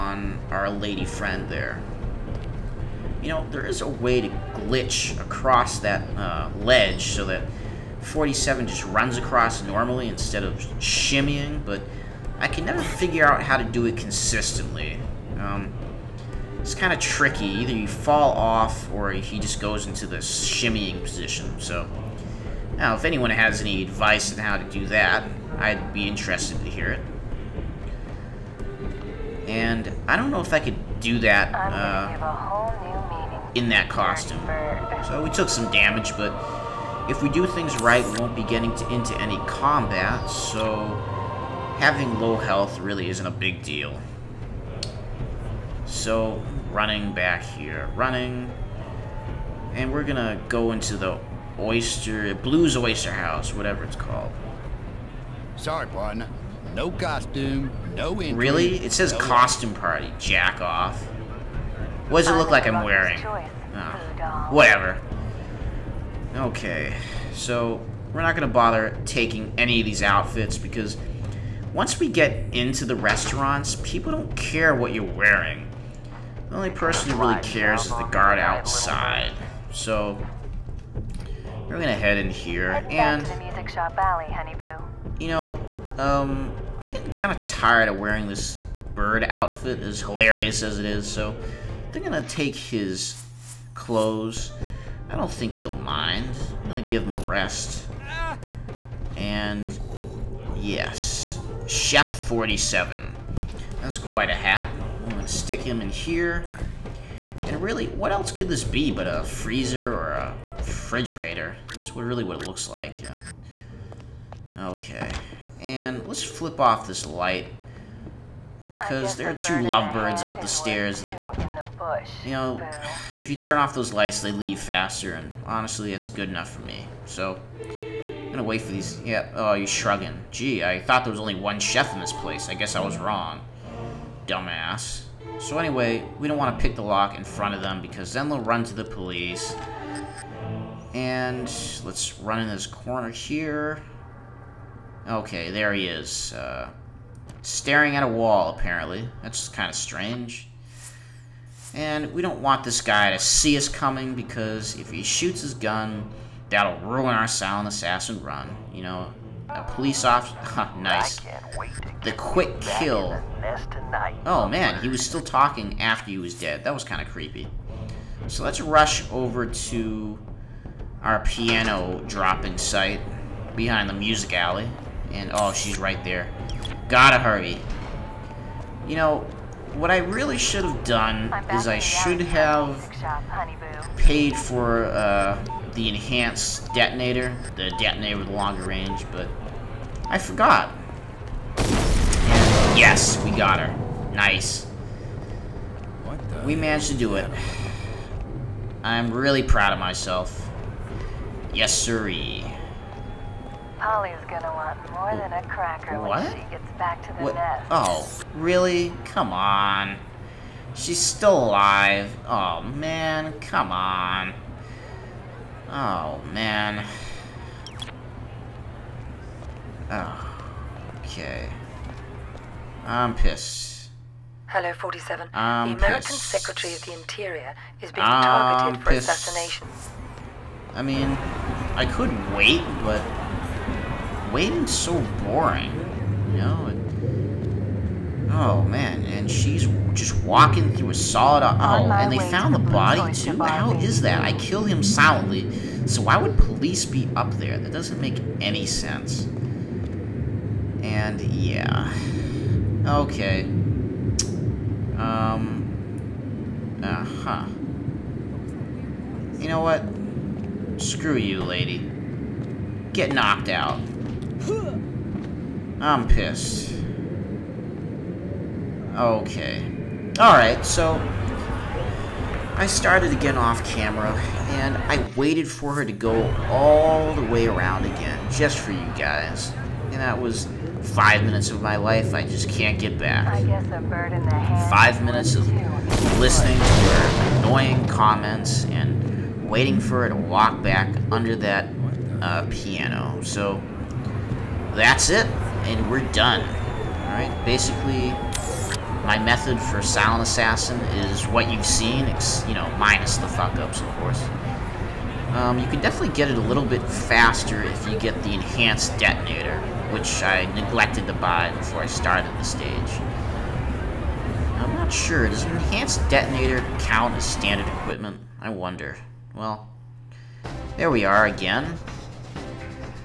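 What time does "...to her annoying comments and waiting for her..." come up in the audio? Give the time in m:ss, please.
4:46.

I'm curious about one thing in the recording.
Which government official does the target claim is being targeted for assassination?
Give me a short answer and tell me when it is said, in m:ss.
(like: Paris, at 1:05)
Secretary of the Interior, at 3:46.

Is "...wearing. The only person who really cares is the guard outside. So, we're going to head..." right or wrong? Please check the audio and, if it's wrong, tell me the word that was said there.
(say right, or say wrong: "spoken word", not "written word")
right.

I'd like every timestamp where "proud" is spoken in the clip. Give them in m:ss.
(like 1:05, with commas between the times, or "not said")
3:19.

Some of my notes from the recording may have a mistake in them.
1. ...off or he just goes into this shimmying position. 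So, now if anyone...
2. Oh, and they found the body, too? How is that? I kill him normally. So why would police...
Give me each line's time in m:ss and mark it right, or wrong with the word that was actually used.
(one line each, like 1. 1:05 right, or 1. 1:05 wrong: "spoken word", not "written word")
1. 0:18 right
2. 4:01 wrong: "silently", not "normally".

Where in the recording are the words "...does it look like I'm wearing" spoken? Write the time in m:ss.
1:02.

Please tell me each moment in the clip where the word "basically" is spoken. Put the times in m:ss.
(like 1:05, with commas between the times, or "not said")
4:57.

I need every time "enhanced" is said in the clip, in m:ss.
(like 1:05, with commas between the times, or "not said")
3:05, 5:08, 5:15.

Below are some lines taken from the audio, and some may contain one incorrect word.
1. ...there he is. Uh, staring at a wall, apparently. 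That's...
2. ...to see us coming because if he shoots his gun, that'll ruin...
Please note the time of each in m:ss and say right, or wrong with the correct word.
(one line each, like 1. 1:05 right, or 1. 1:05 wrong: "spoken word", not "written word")
1. 2:25 right
2. 2:33 right.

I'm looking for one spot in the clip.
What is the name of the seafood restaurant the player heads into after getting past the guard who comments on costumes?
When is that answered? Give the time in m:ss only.
0:52.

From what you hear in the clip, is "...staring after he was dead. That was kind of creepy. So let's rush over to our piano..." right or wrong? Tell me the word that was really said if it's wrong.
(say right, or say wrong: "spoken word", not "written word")
wrong: "talking", not "staring".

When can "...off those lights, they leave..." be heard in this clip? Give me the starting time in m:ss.
2:03.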